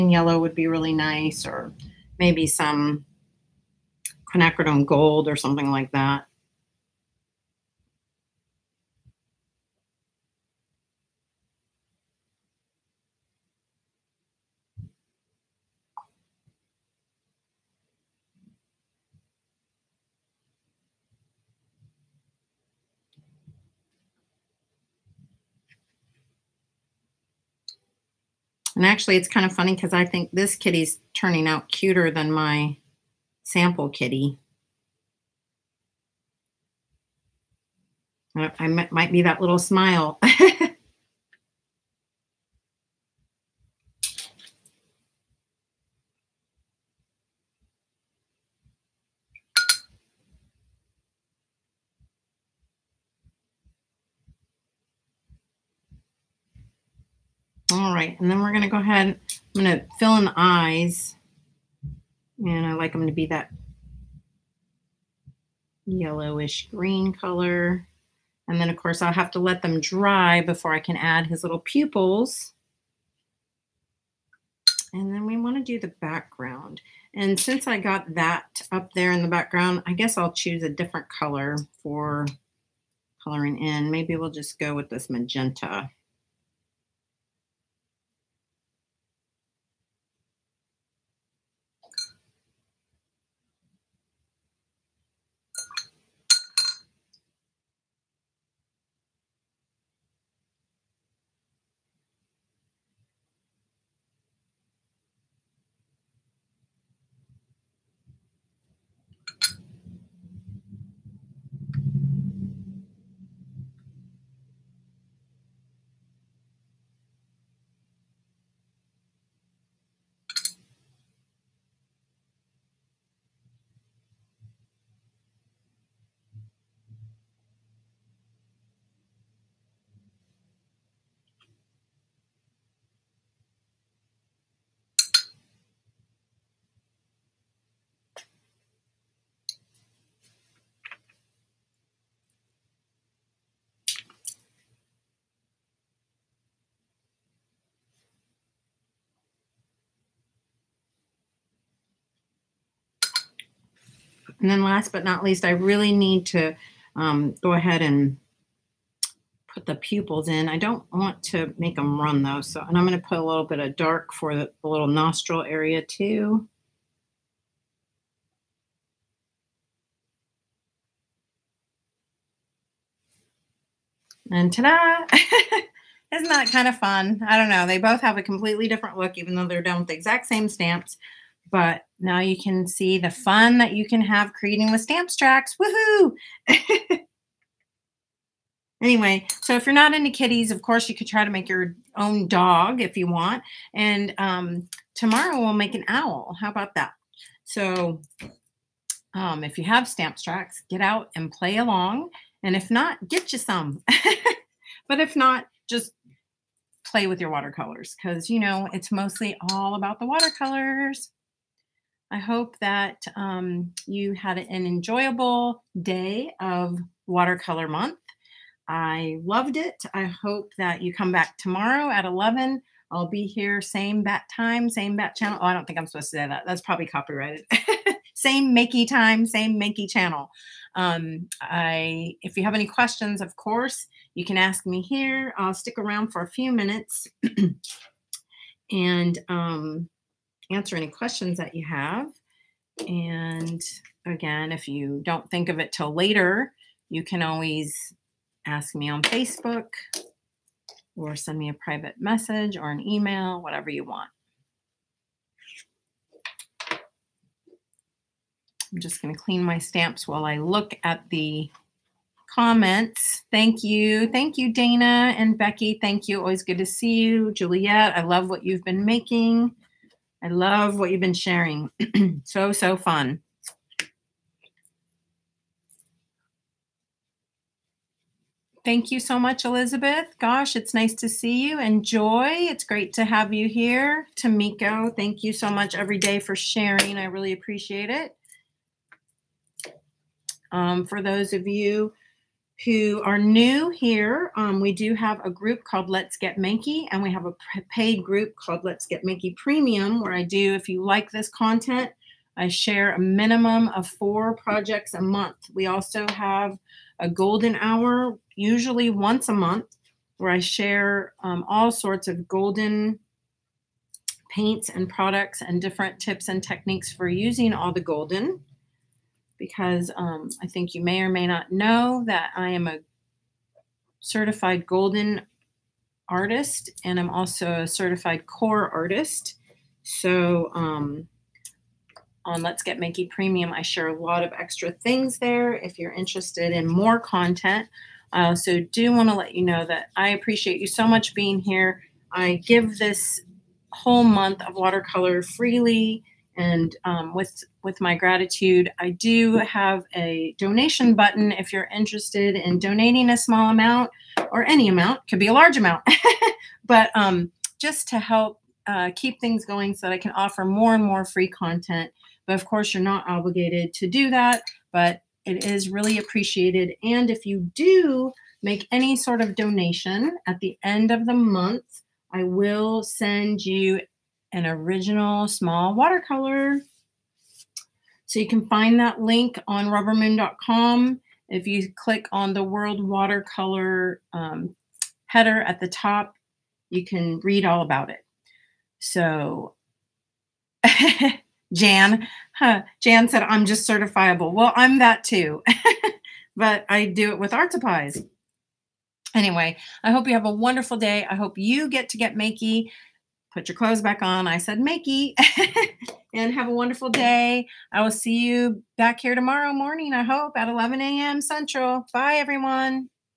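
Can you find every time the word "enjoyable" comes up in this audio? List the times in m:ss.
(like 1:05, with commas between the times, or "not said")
3:34.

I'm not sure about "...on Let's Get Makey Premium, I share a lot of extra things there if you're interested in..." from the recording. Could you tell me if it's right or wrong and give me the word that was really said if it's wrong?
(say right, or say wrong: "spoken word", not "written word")
right.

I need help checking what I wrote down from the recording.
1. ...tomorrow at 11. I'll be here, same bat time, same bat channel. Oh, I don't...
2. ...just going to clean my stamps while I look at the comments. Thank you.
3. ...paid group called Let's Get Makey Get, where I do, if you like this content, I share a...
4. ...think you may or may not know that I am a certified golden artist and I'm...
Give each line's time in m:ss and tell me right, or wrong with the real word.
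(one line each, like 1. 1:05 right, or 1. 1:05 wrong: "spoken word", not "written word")
1. 3:41 right
2. 4:18 right
3. 4:57 wrong: "Premium", not "Get"
4. 5:20 right.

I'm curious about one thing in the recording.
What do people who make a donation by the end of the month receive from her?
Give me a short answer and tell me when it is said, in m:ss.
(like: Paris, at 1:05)
Original small watercolor, at 6:14.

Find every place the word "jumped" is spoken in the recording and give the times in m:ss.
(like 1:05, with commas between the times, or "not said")
not said.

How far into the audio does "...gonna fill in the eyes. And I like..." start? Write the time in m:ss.
0:59.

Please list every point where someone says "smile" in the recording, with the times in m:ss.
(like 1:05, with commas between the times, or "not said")
0:39.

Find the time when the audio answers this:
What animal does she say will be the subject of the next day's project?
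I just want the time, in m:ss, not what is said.
3:15.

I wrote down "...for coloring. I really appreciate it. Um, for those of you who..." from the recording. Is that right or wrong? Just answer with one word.
wrong.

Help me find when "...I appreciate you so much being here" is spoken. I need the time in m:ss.
5:39.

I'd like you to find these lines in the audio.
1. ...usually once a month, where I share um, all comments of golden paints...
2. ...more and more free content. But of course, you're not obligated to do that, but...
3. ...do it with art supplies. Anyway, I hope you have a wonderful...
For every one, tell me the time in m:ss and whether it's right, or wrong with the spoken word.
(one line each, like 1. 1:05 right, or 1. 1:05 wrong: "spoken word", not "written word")
1. 5:08 wrong: "sorts", not "comments"
2. 6:00 right
3. 6:36 right.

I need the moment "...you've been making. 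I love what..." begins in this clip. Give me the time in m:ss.
4:28.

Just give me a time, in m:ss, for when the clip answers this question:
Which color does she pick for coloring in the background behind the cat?
1:25.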